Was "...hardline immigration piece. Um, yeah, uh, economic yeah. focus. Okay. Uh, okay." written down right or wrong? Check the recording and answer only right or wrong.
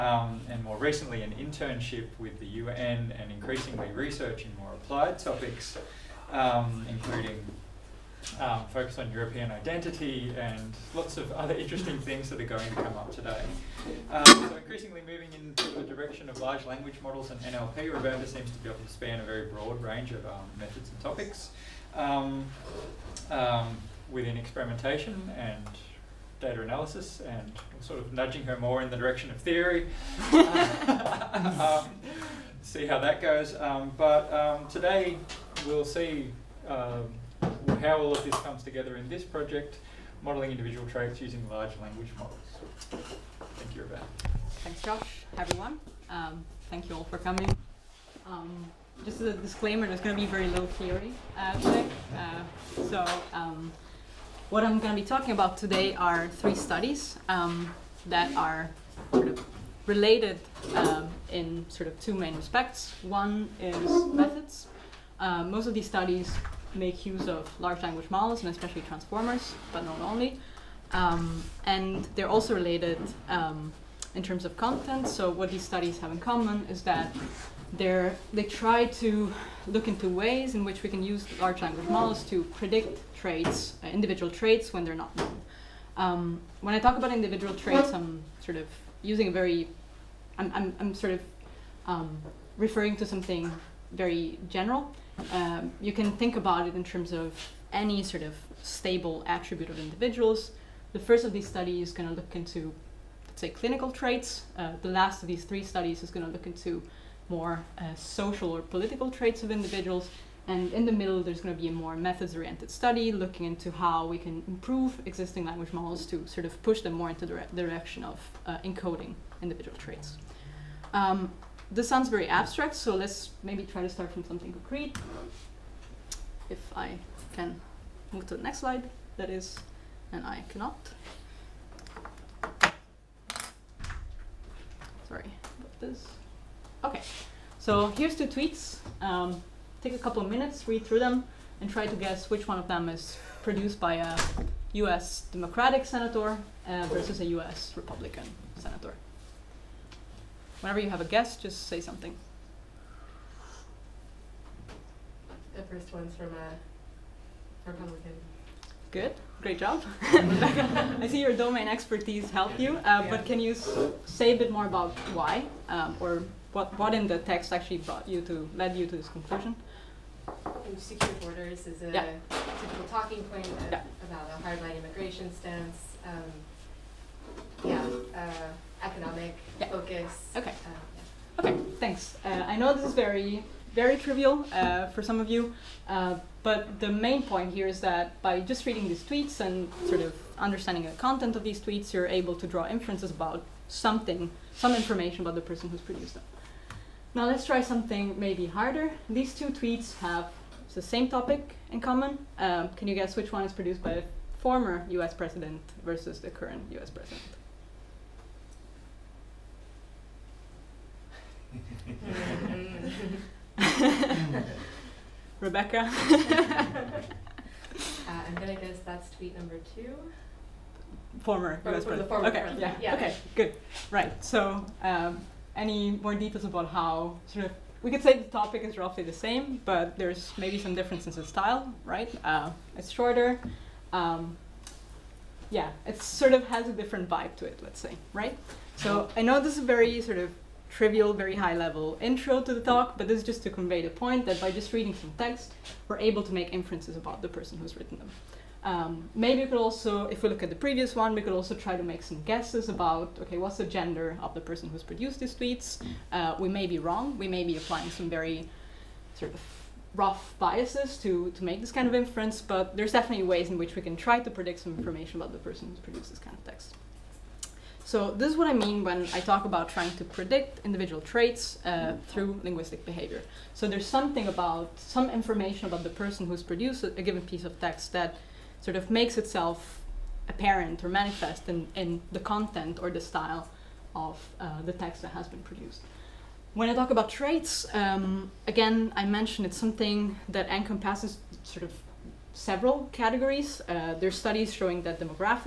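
wrong.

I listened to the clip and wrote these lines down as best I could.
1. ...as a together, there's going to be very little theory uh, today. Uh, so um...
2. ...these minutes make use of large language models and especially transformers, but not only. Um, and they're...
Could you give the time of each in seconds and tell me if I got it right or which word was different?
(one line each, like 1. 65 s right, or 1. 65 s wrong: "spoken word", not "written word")
1. 49 s wrong: "disclaimer", not "together"
2. 65 s wrong: "studies", not "minutes".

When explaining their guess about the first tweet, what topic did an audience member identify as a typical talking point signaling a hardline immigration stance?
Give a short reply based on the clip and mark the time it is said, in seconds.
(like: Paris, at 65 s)
Secure borders, at 170 s.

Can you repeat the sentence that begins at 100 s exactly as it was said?
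The first of these studies is going to look into, let's say, clinical traits.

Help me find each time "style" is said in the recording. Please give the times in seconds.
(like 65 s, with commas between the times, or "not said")
231 s, 283 s.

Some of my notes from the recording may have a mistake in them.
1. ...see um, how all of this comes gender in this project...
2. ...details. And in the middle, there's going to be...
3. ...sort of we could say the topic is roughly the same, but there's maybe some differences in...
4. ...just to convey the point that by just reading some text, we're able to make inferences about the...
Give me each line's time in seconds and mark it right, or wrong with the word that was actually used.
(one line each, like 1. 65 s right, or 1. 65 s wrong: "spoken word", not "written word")
1. 35 s wrong: "together", not "gender"
2. 109 s wrong: "individuals", not "details"
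3. 227 s right
4. 243 s right.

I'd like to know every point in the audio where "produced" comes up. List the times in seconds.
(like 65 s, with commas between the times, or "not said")
143 s, 195 s, 203 s, 254 s, 265 s, 276 s, 285 s.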